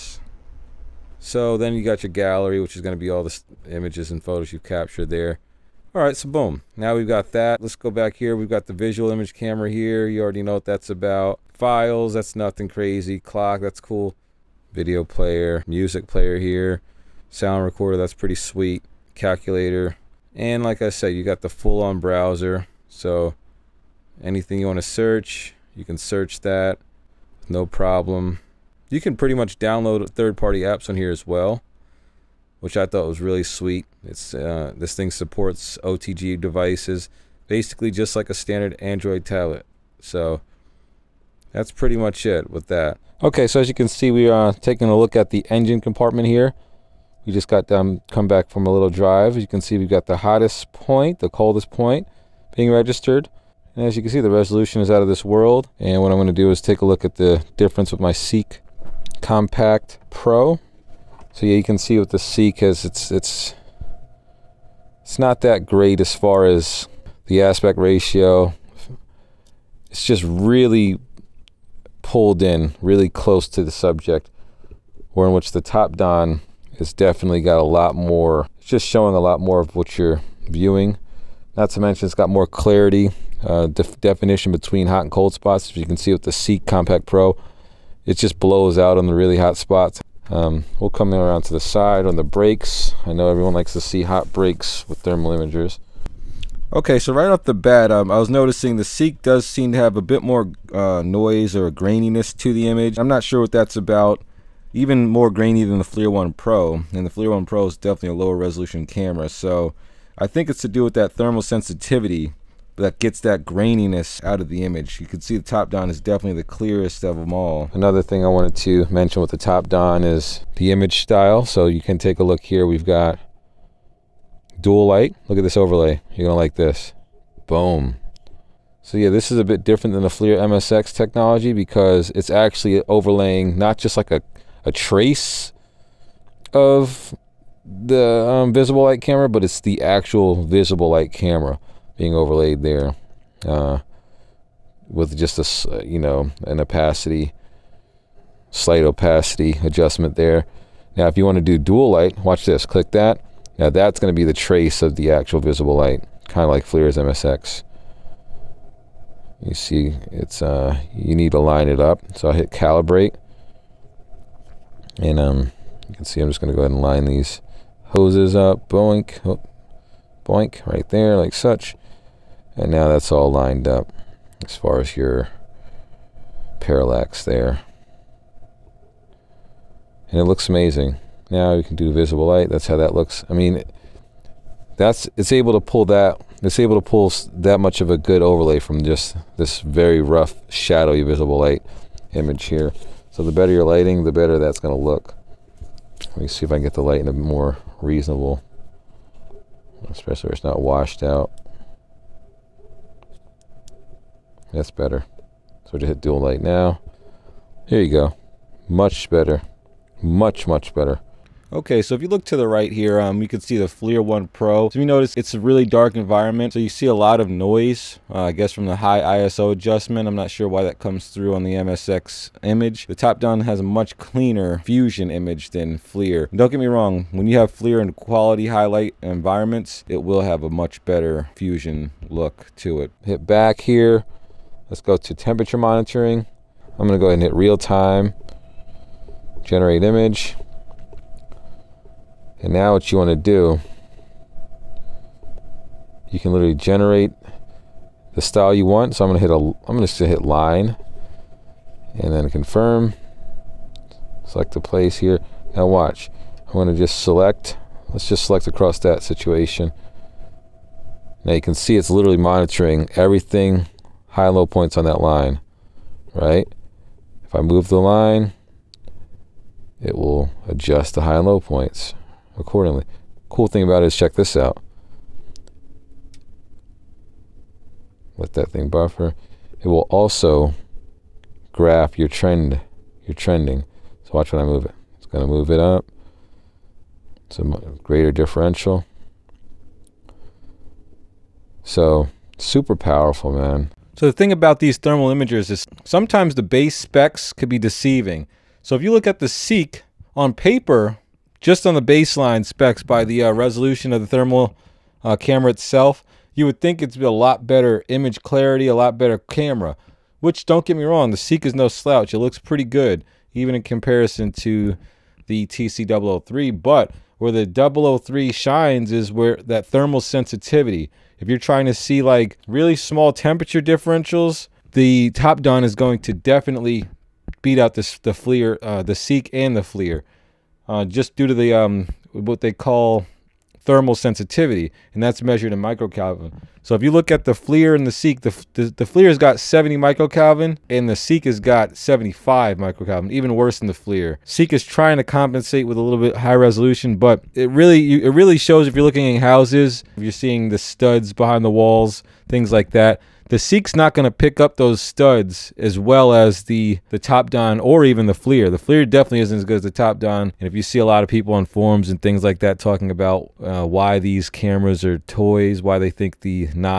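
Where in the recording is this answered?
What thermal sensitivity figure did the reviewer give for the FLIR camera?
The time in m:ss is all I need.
5:39.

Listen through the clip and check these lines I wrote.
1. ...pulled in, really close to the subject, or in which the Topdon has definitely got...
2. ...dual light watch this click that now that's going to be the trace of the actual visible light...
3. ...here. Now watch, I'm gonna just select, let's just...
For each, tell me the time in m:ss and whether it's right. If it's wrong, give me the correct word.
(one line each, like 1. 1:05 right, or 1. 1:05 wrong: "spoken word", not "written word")
1. 1:12 right
2. 2:31 right
3. 4:14 right.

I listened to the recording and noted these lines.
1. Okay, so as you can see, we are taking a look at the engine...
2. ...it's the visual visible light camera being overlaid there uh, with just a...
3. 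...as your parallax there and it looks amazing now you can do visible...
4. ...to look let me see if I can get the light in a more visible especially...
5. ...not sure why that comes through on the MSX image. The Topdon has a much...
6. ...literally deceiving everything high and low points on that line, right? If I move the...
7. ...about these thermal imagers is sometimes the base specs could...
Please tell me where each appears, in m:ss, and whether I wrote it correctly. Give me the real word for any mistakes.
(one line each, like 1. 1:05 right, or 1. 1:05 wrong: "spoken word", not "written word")
1. 0:43 right
2. 2:19 wrong: "actual", not "visual"
3. 2:54 right
4. 3:14 wrong: "reasonable", not "visible"
5. 3:40 right
6. 4:21 wrong: "monitoring", not "deceiving"
7. 4:54 right.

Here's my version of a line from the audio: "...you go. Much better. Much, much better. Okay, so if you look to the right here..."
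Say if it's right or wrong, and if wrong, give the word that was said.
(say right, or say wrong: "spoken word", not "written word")
right.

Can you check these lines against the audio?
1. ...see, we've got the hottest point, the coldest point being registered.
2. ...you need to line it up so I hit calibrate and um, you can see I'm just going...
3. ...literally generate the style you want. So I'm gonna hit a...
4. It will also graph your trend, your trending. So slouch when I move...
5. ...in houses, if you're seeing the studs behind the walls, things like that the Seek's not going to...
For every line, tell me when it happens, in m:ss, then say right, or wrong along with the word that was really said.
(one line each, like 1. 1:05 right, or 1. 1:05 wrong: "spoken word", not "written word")
1. 0:49 right
2. 2:40 right
3. 4:06 right
4. 4:39 wrong: "watch", not "slouch"
5. 5:49 right.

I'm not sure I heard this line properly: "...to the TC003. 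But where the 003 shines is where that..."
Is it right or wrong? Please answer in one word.
right.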